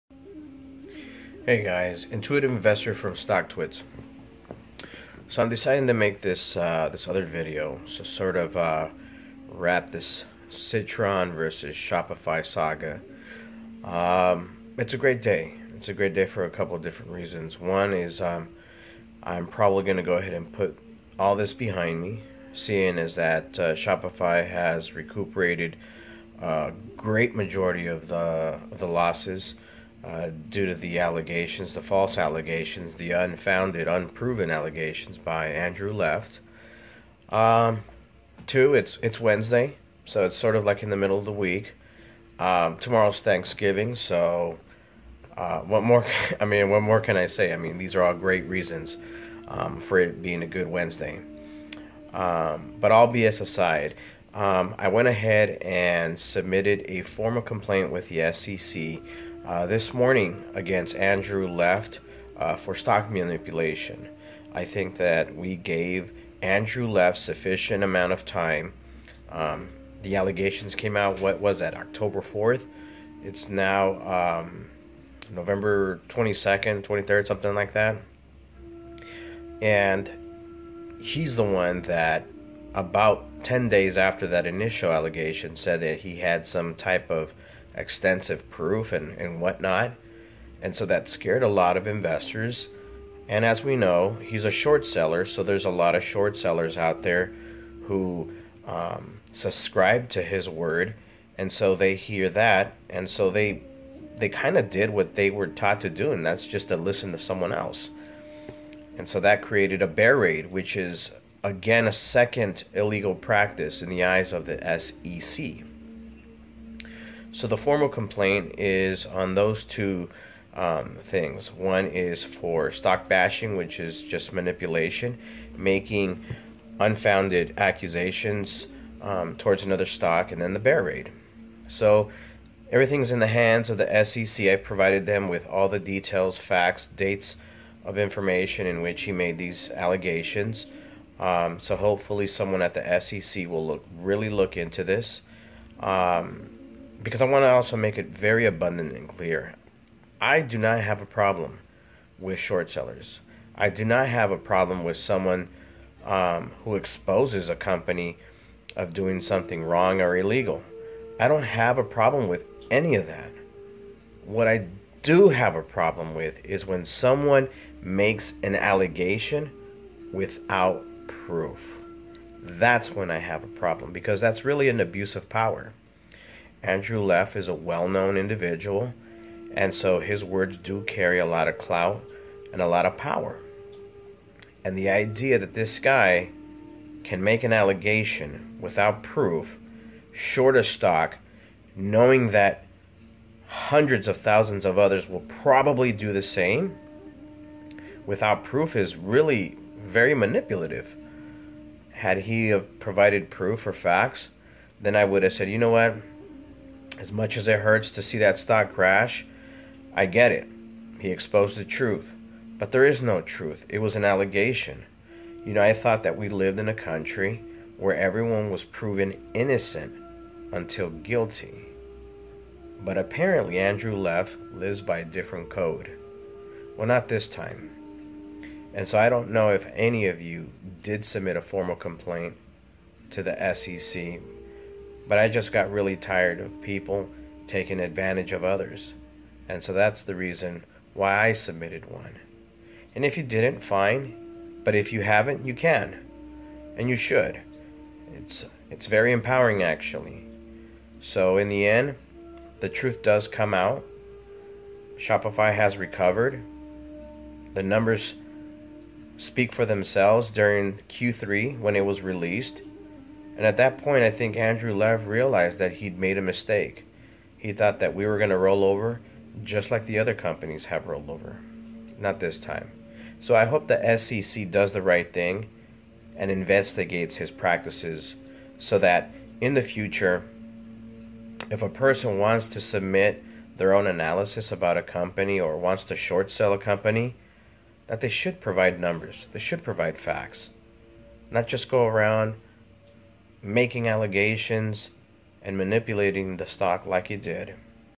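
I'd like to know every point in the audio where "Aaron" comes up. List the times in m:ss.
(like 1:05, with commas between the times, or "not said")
not said.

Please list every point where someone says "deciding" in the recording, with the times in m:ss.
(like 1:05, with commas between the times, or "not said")
0:05.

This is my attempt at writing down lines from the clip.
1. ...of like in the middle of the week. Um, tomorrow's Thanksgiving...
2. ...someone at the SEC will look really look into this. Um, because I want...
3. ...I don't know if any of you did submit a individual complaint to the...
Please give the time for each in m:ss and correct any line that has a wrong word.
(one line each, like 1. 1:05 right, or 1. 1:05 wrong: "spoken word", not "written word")
1. 0:40 right
2. 2:22 right
3. 3:48 wrong: "formal", not "individual".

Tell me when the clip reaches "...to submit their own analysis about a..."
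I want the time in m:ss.
4:42.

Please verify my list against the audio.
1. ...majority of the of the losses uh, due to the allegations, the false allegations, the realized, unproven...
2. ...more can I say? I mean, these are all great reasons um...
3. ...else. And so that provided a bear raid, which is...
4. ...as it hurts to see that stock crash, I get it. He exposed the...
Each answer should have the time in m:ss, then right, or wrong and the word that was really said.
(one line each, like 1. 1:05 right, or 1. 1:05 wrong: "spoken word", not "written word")
1. 0:27 wrong: "unfounded", not "realized"
2. 0:46 right
3. 1:47 wrong: "created", not "provided"
4. 3:27 right.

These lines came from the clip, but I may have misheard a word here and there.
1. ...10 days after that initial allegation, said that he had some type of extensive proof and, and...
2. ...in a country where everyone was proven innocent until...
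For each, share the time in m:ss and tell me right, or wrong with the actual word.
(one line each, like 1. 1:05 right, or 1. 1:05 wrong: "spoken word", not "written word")
1. 1:23 right
2. 3:36 right.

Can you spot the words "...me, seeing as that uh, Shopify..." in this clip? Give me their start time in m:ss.
0:22.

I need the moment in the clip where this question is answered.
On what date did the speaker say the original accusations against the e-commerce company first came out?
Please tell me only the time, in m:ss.
1:11.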